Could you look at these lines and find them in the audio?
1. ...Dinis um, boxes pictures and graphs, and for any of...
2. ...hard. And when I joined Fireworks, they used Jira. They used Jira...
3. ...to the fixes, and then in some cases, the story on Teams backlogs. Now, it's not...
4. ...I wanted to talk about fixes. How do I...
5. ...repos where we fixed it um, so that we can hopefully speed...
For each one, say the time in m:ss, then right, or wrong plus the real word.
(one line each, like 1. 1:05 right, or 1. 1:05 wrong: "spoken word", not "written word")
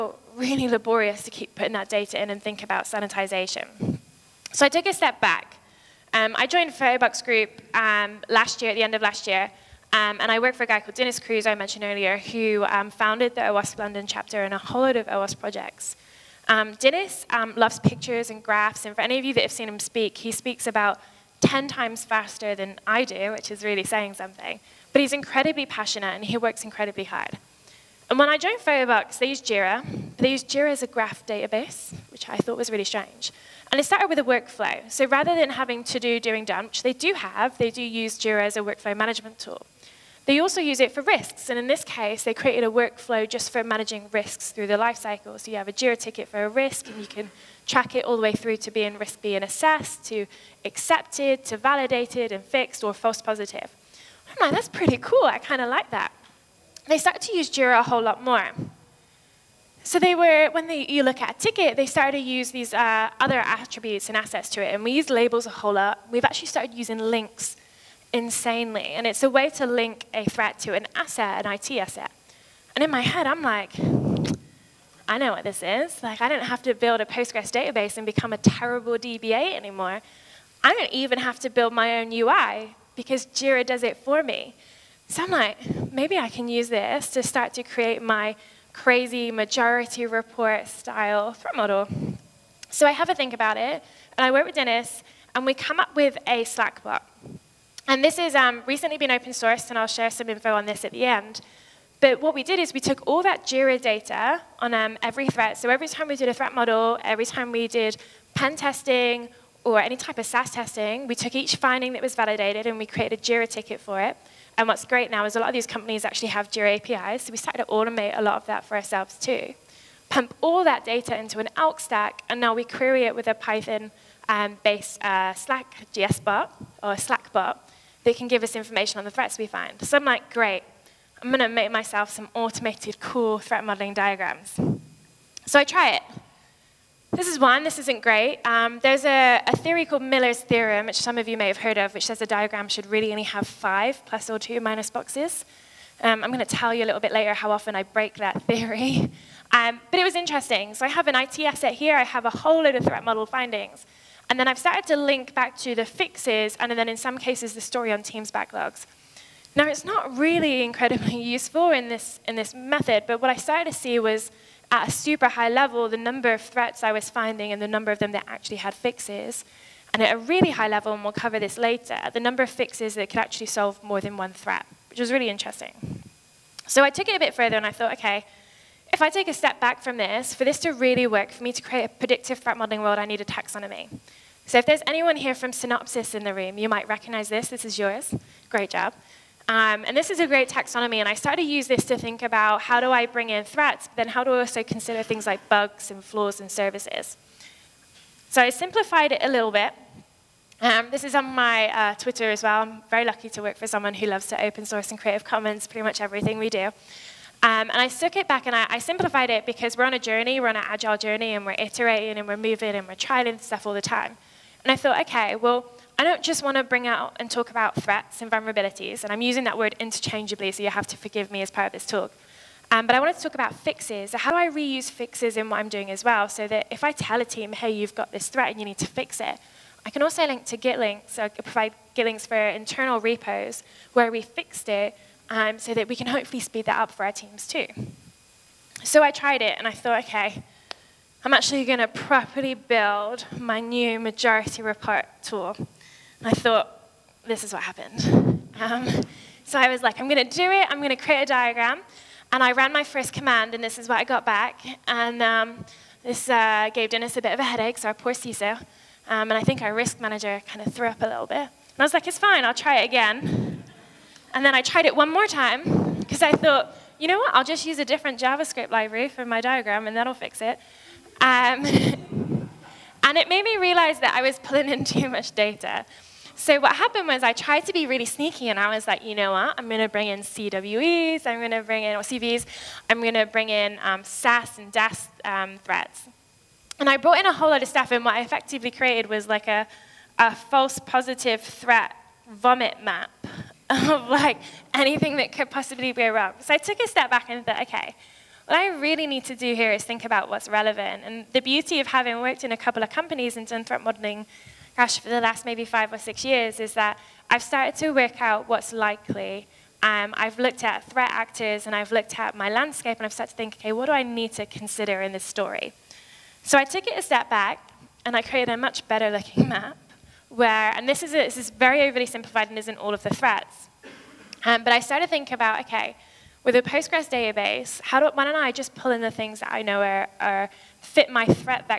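1. 0:16 wrong: "loves", not "boxes"
2. 0:27 right
3. 2:35 right
4. 3:42 right
5. 3:53 right.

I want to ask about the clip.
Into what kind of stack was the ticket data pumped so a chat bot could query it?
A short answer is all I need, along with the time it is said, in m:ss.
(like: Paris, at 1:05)
ELK stack, at 2:01.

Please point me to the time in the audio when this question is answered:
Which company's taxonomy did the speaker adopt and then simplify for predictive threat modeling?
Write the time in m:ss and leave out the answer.
3:05.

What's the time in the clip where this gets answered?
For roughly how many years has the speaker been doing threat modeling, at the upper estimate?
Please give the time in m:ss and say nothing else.
5:05.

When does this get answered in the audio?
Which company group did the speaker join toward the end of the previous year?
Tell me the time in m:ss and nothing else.
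0:06.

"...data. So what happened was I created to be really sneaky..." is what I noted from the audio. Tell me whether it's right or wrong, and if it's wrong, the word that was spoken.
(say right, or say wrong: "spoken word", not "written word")
wrong: "tried", not "created".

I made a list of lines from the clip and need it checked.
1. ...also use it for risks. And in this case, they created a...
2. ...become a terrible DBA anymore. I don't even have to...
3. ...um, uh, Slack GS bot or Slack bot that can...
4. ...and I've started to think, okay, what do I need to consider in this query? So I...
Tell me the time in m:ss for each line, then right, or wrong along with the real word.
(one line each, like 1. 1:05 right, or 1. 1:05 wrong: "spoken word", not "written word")
1. 0:40 right
2. 1:18 right
3. 2:05 right
4. 5:12 wrong: "story", not "query".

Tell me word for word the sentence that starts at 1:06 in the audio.
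We've actually started using links insanely, and it's a way to link a threat to an asset, an IT asset.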